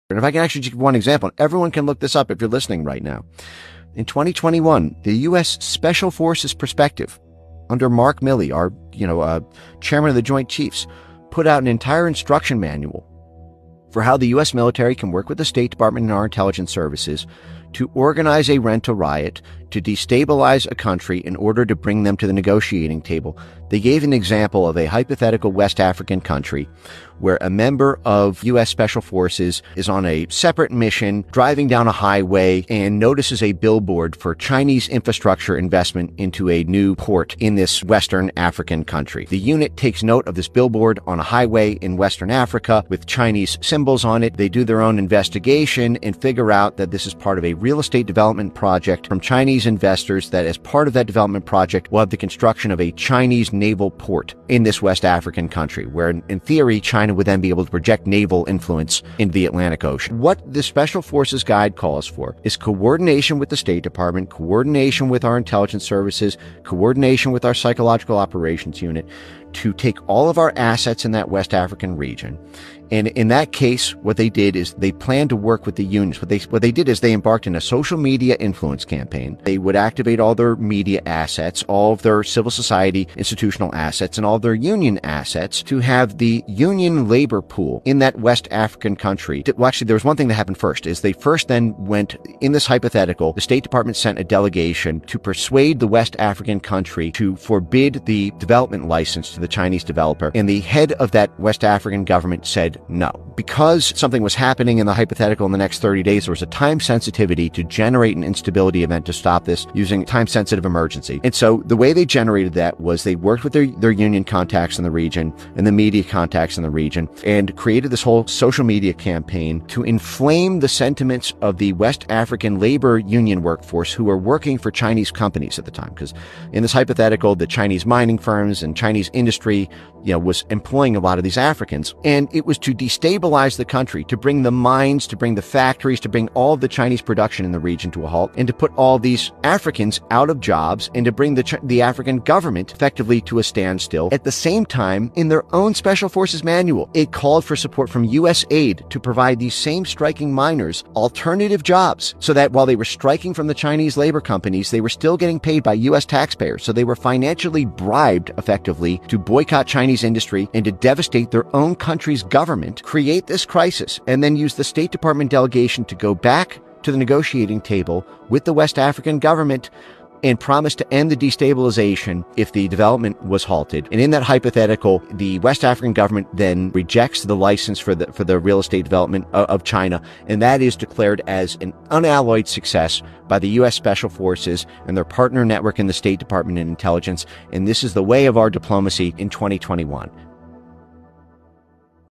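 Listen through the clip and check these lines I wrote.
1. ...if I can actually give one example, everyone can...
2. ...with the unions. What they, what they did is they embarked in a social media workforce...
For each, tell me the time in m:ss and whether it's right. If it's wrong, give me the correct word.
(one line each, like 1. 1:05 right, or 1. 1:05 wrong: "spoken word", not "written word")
1. 0:00 right
2. 1:15 wrong: "influence", not "workforce".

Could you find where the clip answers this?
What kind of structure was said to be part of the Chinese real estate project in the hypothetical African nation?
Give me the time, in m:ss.
0:52.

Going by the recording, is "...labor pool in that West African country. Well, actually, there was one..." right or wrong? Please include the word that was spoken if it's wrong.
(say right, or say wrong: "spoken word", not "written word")
right.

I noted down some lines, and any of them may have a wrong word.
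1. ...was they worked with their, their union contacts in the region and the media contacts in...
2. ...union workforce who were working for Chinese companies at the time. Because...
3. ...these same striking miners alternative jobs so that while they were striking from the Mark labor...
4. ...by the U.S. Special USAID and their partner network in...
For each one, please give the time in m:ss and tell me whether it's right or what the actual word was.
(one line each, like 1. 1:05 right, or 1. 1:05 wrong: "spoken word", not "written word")
1. 1:52 right
2. 2:02 right
3. 2:29 wrong: "Chinese", not "Mark"
4. 3:03 wrong: "Forces", not "USAID".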